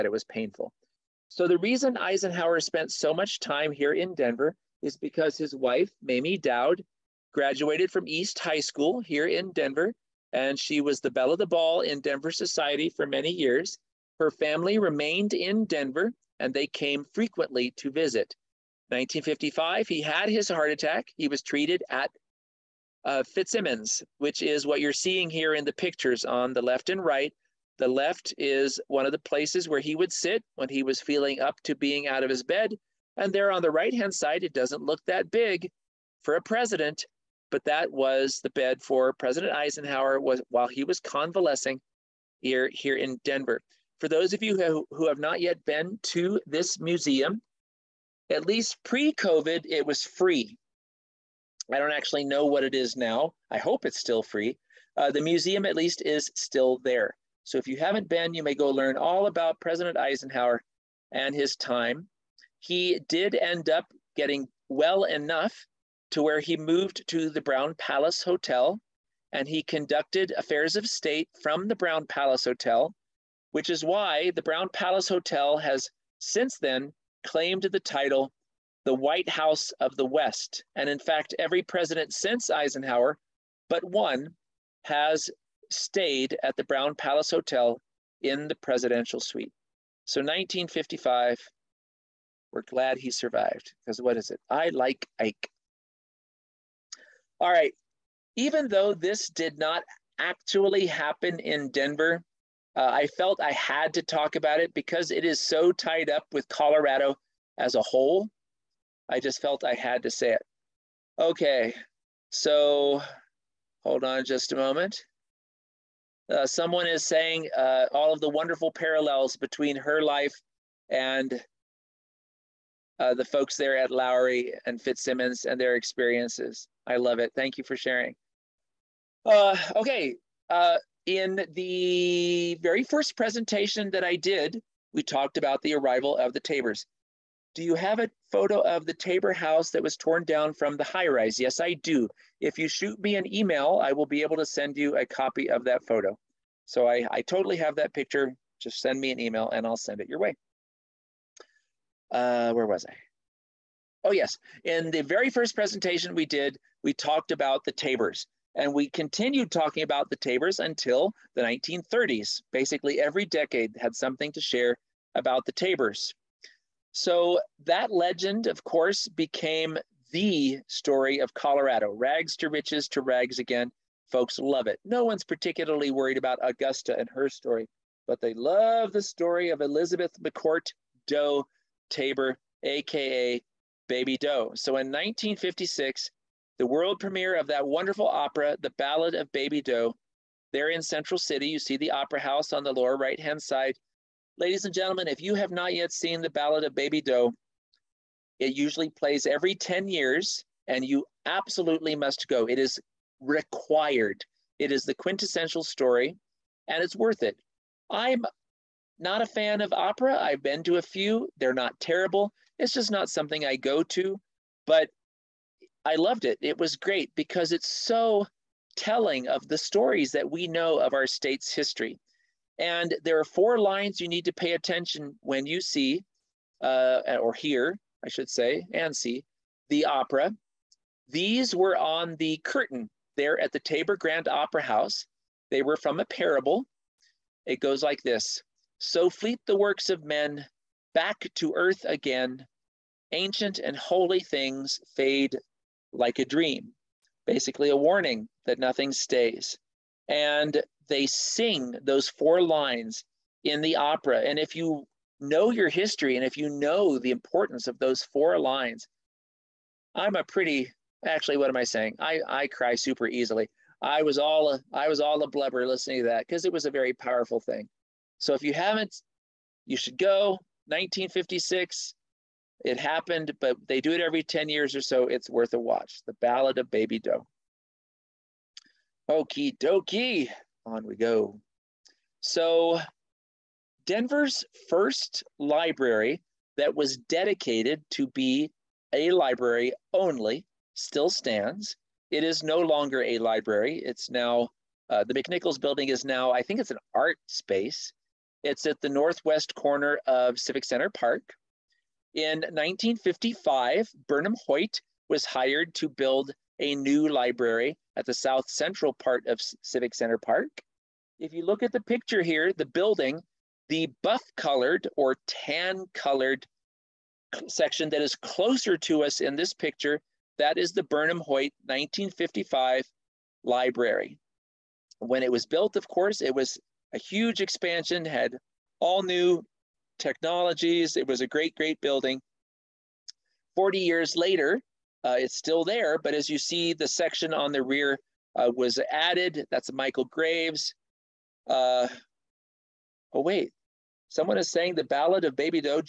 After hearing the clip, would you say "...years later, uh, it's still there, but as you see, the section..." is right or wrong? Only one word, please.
right.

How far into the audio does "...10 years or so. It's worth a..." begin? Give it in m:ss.
4:34.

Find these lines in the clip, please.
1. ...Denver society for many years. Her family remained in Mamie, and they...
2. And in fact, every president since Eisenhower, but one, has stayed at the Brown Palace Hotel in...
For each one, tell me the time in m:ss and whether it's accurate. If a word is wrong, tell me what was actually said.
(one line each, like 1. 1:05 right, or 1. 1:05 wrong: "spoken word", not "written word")
1. 0:12 wrong: "Denver", not "Mamie"
2. 1:20 right.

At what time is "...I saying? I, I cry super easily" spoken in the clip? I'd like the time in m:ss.
4:21.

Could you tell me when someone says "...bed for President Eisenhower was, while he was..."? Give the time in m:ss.
0:38.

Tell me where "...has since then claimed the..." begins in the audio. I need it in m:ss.
1:15.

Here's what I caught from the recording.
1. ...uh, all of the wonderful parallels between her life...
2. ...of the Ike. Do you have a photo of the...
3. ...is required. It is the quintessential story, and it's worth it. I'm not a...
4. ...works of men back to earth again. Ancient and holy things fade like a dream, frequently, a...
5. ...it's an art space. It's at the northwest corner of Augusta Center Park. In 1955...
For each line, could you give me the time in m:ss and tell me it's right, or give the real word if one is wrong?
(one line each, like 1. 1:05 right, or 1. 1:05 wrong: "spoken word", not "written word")
1. 1:57 right
2. 2:16 wrong: "Tabors", not "Ike"
3. 3:22 right
4. 3:59 wrong: "basically", not "frequently"
5. 4:56 wrong: "Civic", not "Augusta".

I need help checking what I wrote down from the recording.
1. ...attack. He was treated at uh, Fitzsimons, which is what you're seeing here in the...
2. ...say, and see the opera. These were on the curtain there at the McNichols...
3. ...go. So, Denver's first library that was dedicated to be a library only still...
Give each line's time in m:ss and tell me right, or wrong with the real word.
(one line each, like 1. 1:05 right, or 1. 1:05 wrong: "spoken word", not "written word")
1. 0:20 right
2. 3:48 wrong: "Tabor", not "McNichols"
3. 4:40 right.